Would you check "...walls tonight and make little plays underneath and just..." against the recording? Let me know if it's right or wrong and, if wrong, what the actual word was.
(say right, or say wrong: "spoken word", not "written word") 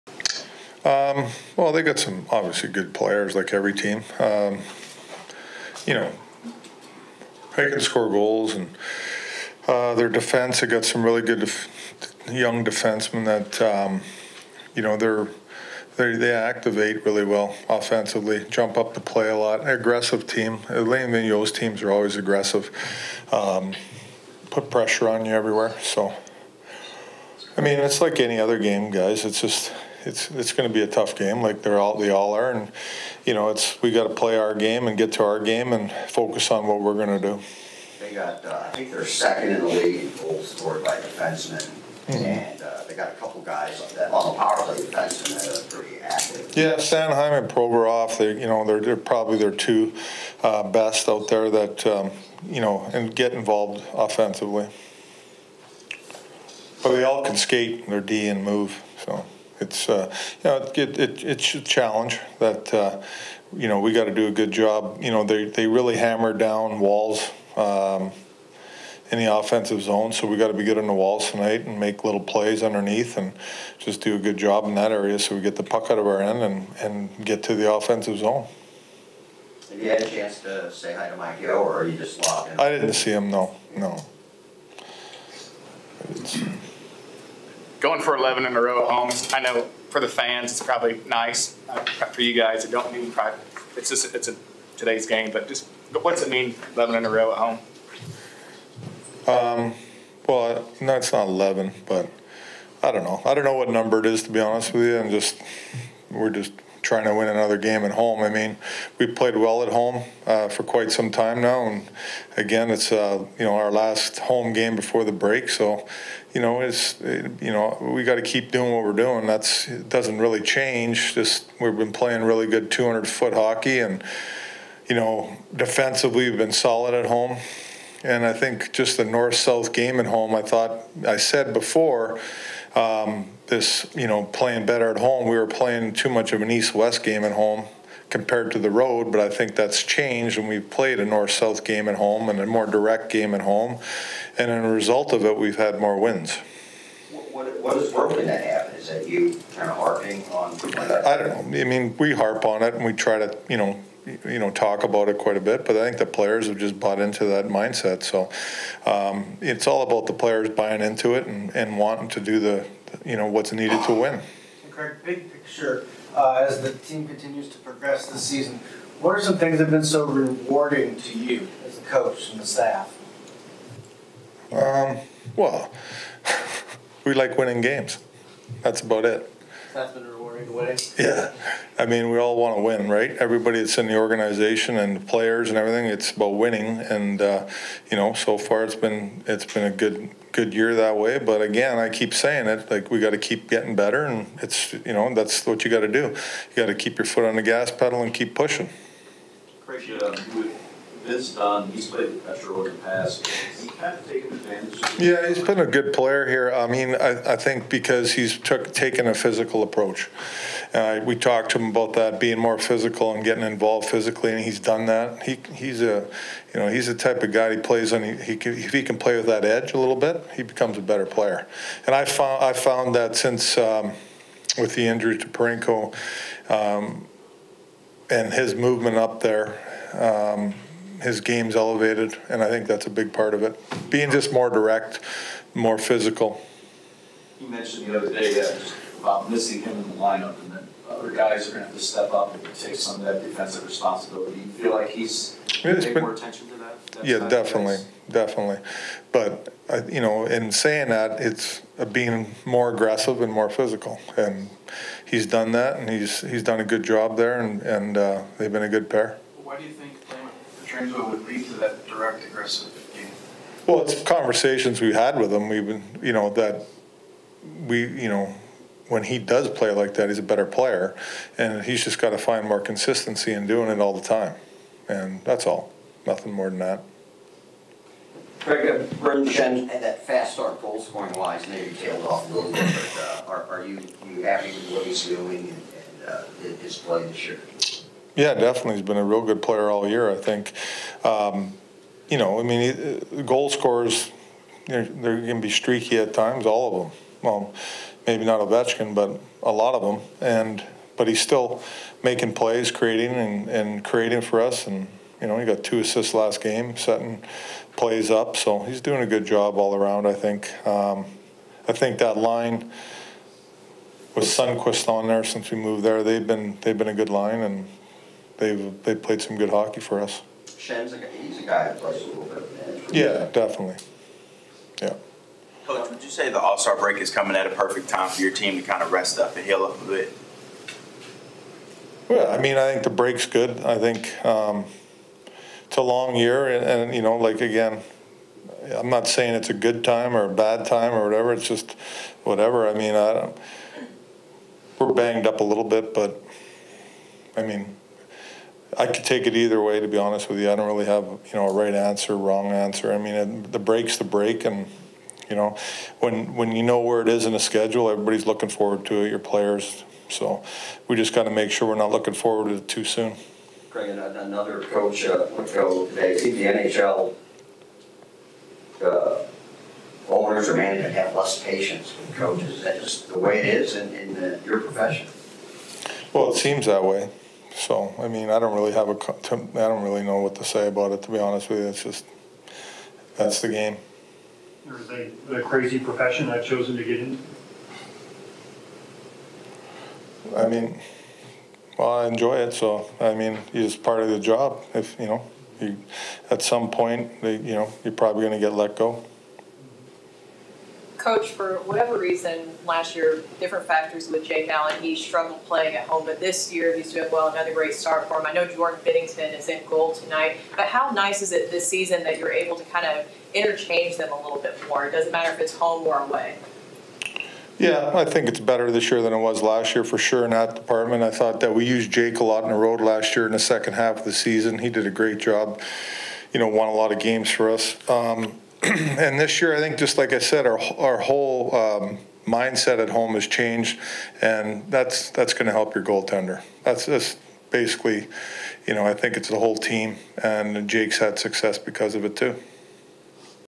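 right.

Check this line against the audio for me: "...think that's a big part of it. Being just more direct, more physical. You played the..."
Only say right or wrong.
wrong.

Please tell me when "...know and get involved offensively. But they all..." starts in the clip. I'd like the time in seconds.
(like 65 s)
52 s.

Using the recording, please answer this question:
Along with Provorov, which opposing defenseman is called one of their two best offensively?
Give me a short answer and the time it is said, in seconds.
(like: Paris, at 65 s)
Sanheim, at 46 s.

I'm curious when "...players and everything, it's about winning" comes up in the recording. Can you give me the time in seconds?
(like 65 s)
184 s.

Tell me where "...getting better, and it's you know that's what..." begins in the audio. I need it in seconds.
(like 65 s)
193 s.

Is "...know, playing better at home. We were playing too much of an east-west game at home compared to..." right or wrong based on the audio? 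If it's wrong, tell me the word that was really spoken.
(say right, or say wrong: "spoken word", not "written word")
right.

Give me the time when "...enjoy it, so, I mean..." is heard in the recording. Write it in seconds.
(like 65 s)
392 s.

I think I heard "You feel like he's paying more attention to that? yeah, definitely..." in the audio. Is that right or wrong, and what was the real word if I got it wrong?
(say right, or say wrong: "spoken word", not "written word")
right.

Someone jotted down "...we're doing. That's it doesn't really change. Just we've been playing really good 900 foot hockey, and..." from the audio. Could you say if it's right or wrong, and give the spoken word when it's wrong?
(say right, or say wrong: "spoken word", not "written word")
wrong: "200", not "900".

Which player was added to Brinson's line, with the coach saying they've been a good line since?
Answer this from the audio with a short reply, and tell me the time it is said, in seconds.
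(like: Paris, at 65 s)
Sundqvist, at 314 s.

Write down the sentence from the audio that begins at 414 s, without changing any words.
It doesn't matter if it's home or away.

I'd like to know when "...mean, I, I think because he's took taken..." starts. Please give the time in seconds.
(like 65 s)
206 s.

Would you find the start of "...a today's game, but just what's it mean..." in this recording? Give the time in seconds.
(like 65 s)
94 s.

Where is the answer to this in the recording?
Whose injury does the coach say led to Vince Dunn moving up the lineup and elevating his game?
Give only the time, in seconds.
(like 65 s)
225 s.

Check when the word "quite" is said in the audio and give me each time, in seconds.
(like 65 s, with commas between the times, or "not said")
110 s, 155 s.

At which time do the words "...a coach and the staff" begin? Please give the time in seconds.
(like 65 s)
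171 s.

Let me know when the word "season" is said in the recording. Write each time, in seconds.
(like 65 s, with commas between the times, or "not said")
168 s, 411 s, 424 s.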